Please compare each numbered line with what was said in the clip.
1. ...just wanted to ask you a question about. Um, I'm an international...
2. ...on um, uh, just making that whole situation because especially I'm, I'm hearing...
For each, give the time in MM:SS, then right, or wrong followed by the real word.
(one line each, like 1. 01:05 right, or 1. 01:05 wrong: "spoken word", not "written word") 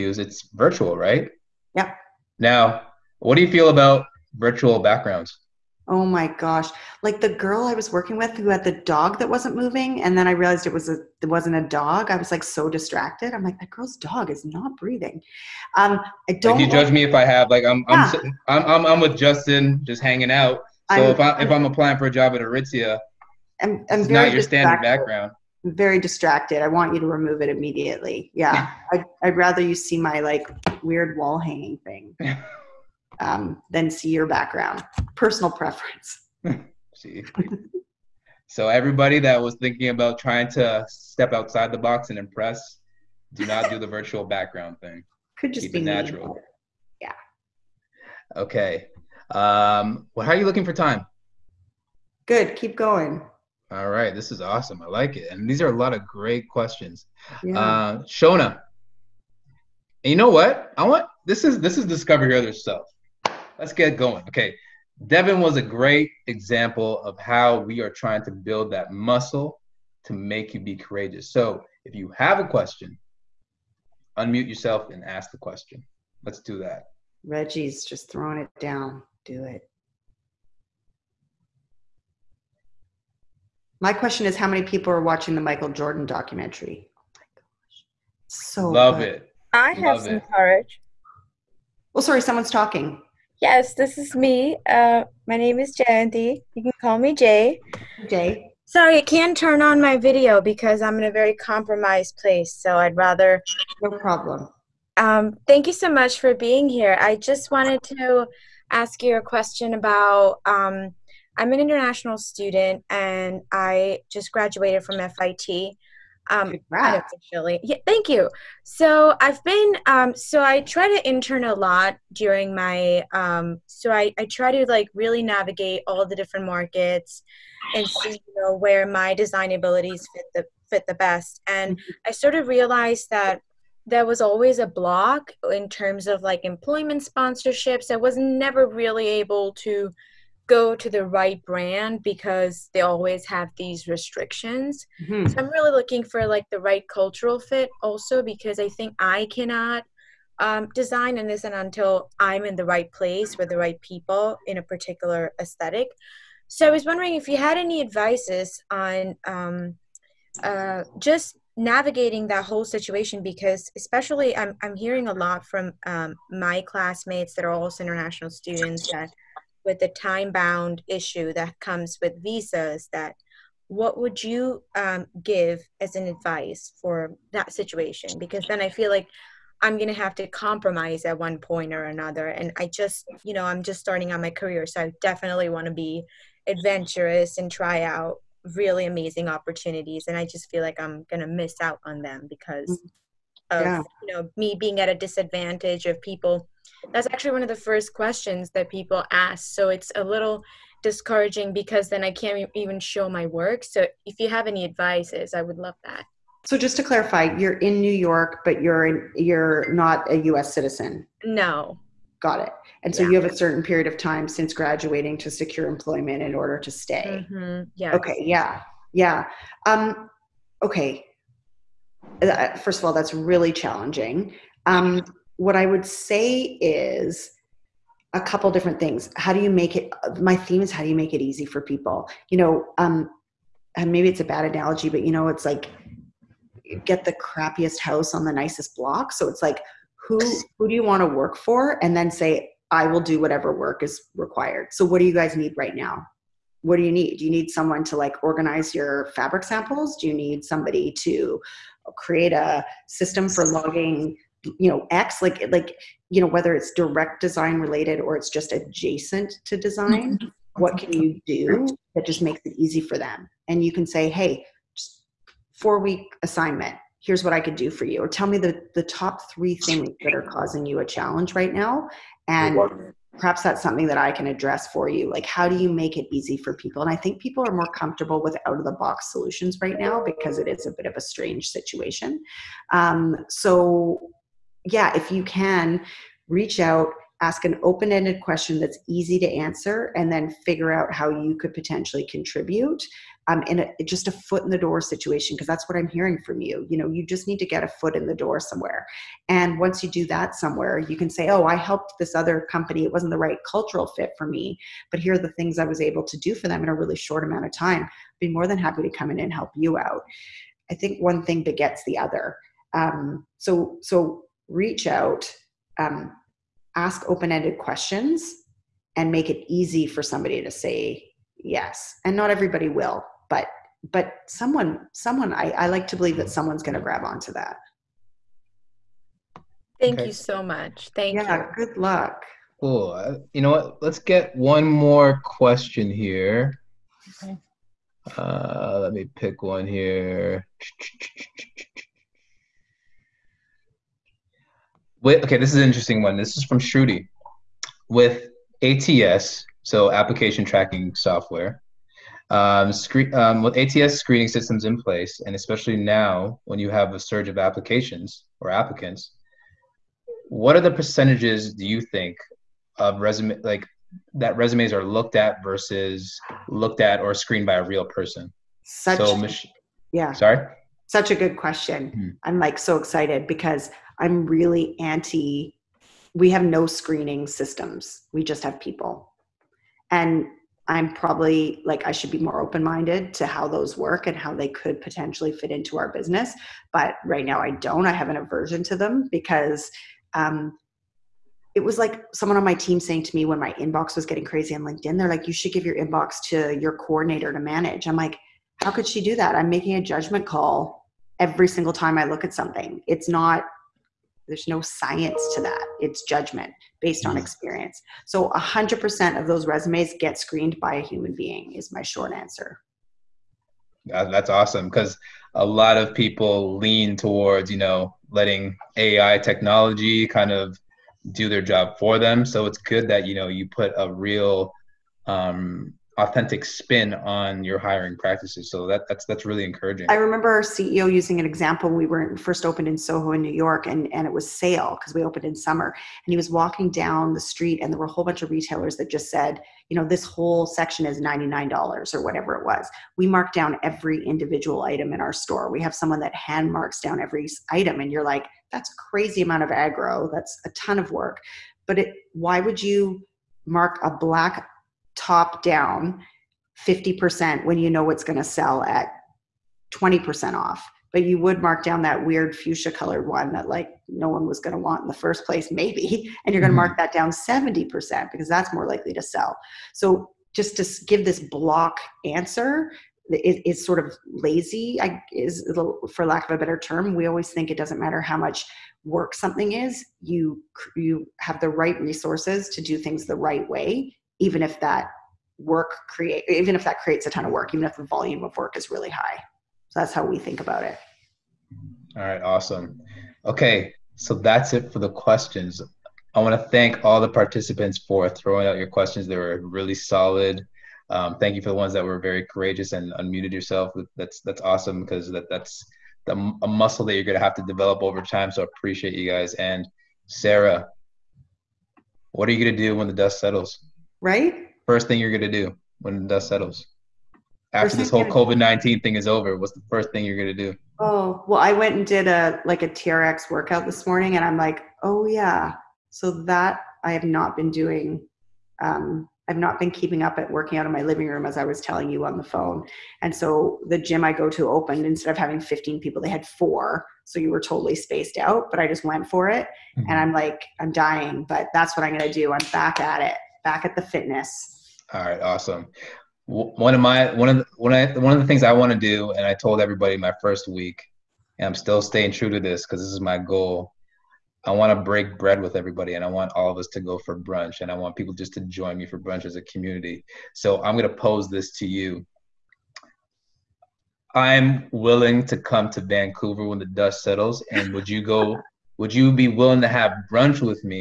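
1. 01:47 right
2. 02:38 wrong: "navigating", not "making".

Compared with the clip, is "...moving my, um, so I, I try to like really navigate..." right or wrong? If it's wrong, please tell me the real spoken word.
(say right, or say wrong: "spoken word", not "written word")
wrong: "during", not "moving".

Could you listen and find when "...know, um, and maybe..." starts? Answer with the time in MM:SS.
03:52.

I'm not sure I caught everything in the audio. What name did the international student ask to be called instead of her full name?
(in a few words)
Jay.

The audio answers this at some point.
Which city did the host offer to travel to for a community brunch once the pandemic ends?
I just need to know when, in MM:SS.
09:25.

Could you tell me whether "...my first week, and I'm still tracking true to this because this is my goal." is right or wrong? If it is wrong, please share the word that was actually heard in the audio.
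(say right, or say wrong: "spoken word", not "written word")
wrong: "staying", not "tracking".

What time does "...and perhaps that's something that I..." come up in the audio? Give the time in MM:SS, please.
04:32.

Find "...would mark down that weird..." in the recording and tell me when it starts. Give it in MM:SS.
07:41.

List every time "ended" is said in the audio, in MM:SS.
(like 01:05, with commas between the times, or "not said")
04:47, 05:17.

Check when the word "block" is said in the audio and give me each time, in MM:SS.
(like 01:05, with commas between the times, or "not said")
02:14, 03:58, 07:51.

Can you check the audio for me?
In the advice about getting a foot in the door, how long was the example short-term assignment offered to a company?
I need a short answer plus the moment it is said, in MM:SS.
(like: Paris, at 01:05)
4 weeks, at 04:25.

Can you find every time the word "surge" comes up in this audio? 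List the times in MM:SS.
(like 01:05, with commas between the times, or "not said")
05:56.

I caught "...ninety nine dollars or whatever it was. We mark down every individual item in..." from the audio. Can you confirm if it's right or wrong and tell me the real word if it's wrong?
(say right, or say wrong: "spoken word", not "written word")
right.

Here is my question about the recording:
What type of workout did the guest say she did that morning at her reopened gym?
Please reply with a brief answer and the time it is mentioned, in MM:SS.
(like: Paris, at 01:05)
TRX, at 08:42.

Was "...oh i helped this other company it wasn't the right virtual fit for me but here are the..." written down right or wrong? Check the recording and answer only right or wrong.
wrong.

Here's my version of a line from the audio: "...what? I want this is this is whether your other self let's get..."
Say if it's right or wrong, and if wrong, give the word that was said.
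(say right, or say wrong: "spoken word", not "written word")
wrong: "discover", not "whether".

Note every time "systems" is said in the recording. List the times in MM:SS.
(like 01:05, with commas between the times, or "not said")
04:12, 05:54, 06:17.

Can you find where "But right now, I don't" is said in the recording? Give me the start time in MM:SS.
06:26.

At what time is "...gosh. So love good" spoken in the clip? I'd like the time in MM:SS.
01:27.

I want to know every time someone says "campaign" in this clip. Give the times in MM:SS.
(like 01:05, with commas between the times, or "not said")
not said.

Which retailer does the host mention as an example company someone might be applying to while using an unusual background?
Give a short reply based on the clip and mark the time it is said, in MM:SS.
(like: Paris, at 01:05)
Aritzia, at 00:22.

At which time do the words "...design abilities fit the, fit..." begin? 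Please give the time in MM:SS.
02:09.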